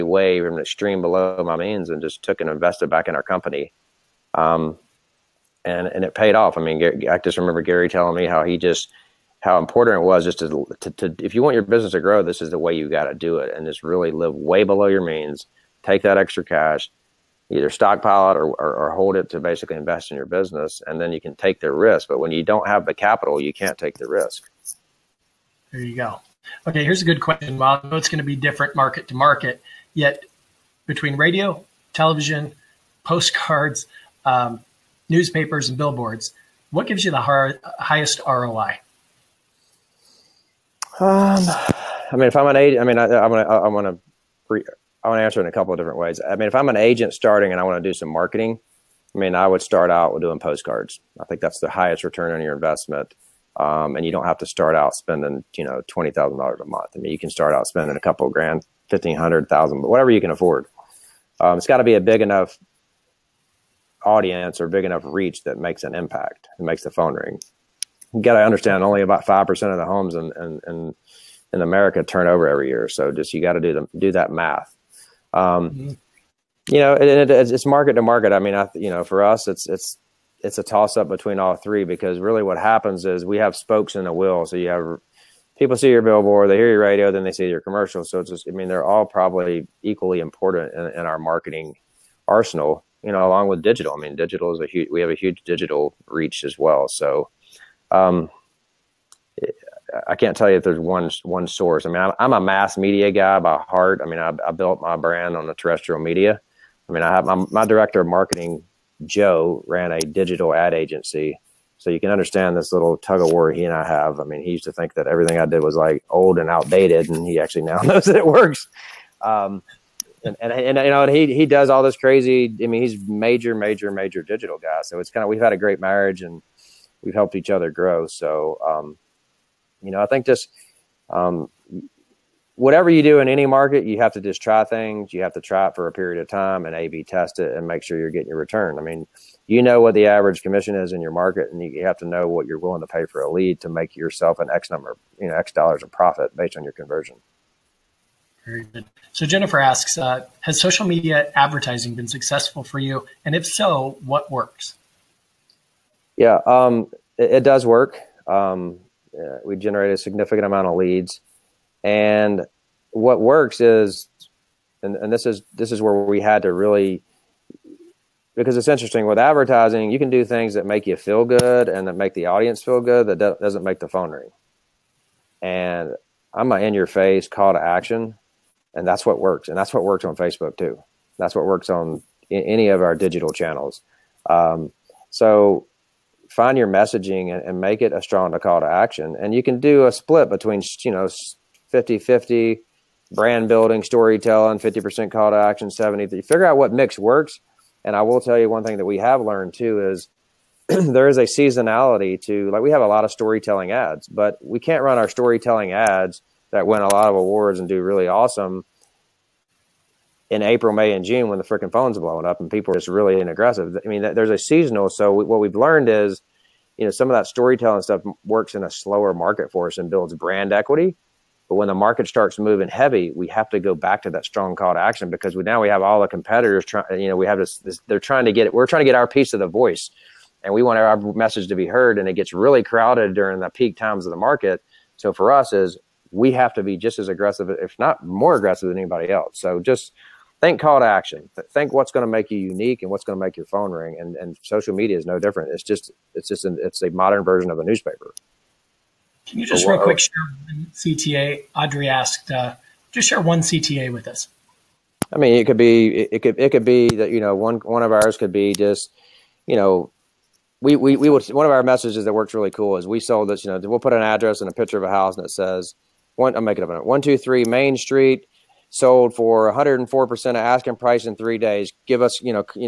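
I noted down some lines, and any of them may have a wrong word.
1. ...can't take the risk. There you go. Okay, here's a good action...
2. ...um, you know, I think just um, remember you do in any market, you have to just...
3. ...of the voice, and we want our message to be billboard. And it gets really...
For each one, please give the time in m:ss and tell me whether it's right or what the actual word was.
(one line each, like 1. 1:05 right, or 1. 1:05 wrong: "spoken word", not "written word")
1. 0:23 wrong: "question", not "action"
2. 2:08 wrong: "whatever", not "remember"
3. 3:49 wrong: "heard", not "billboard".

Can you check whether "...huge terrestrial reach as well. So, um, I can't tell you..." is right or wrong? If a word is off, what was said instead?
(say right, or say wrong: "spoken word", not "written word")
wrong: "digital", not "terrestrial".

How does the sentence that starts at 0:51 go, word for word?
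I think that's the highest return on your investment.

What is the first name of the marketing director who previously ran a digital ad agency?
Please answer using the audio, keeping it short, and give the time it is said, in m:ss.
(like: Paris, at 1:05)
Joe, at 1:49.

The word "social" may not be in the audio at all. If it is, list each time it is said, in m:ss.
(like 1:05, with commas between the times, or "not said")
2:30, 4:04.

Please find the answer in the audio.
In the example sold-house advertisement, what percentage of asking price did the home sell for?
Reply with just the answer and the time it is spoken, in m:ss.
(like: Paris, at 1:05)
104%, at 4:29.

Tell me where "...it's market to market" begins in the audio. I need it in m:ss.
1:17.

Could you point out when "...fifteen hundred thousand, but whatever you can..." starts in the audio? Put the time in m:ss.
0:58.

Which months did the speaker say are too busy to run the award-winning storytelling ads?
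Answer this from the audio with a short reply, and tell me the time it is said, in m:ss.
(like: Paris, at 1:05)
April, May, and June, at 3:30.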